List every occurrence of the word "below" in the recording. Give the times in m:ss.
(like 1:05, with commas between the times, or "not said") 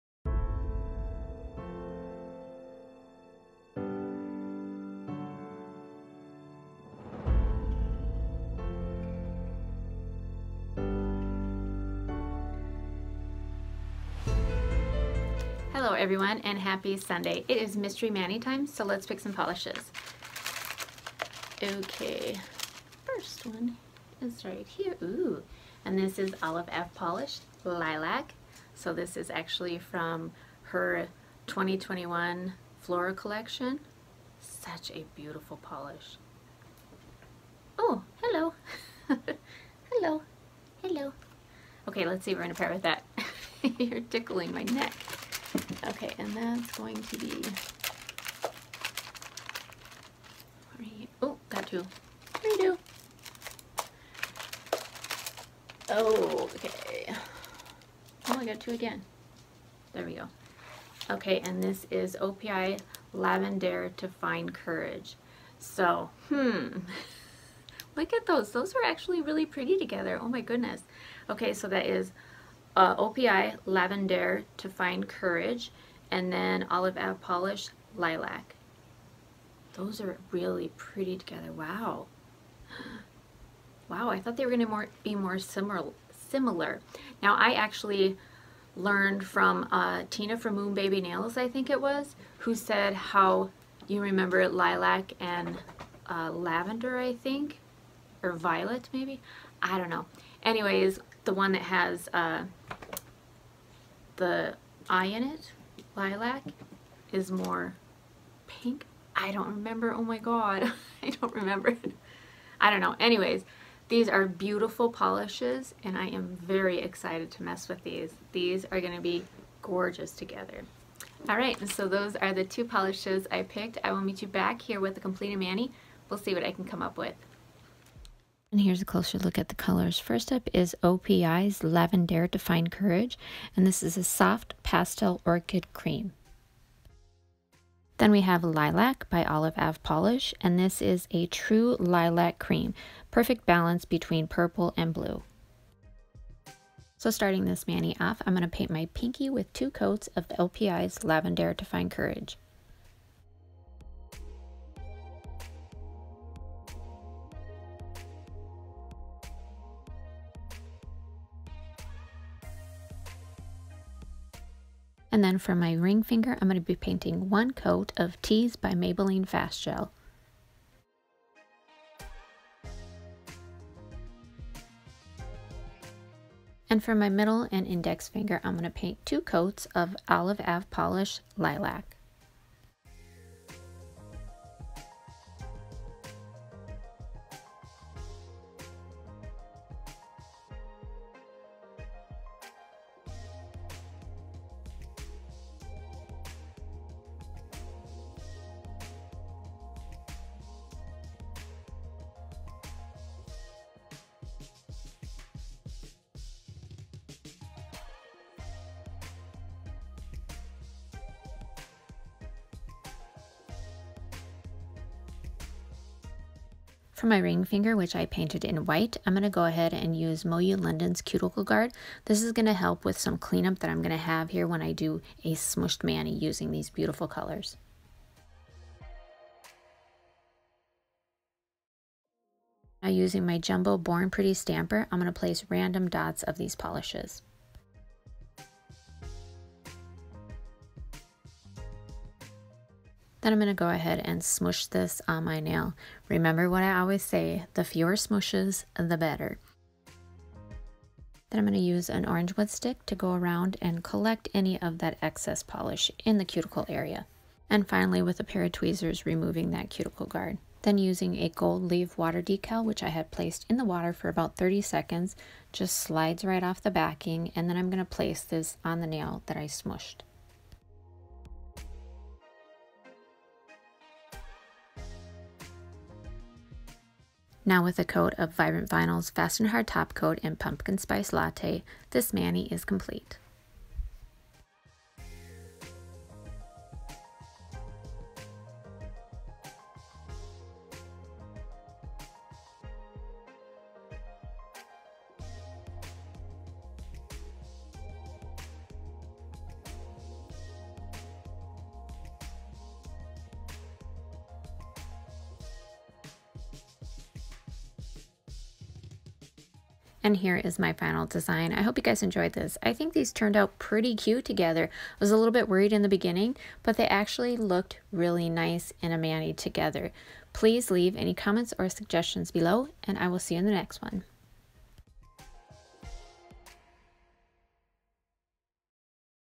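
5:22.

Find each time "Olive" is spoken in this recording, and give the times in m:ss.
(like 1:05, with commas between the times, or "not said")
0:26, 1:16, 2:19, 3:00.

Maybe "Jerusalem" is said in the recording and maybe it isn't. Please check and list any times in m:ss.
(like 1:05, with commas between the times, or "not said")
not said.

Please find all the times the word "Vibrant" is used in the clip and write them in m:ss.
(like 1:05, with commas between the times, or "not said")
4:38.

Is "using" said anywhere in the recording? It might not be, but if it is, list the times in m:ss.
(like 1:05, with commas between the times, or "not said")
3:46, 3:52, 4:20.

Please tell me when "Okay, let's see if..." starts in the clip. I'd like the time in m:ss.
0:41.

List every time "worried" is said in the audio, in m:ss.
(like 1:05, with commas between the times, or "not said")
5:15.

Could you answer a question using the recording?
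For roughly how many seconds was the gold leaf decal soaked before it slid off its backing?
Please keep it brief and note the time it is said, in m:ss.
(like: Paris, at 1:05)
30, at 4:24.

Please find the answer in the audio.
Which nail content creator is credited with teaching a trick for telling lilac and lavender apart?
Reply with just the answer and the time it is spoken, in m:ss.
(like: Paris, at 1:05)
Tina, at 1:30.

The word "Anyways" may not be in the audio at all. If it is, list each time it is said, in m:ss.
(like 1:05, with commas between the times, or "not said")
1:40, 1:52.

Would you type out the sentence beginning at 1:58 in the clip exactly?
These are going to be gorgeous together.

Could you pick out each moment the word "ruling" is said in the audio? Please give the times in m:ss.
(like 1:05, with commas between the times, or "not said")
not said.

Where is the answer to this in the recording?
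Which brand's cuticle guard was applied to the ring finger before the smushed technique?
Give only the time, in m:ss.
3:40.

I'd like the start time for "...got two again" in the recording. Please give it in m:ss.
0:58.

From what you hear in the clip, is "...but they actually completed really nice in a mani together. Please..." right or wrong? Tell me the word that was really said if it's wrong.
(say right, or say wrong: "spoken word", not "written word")
wrong: "looked", not "completed".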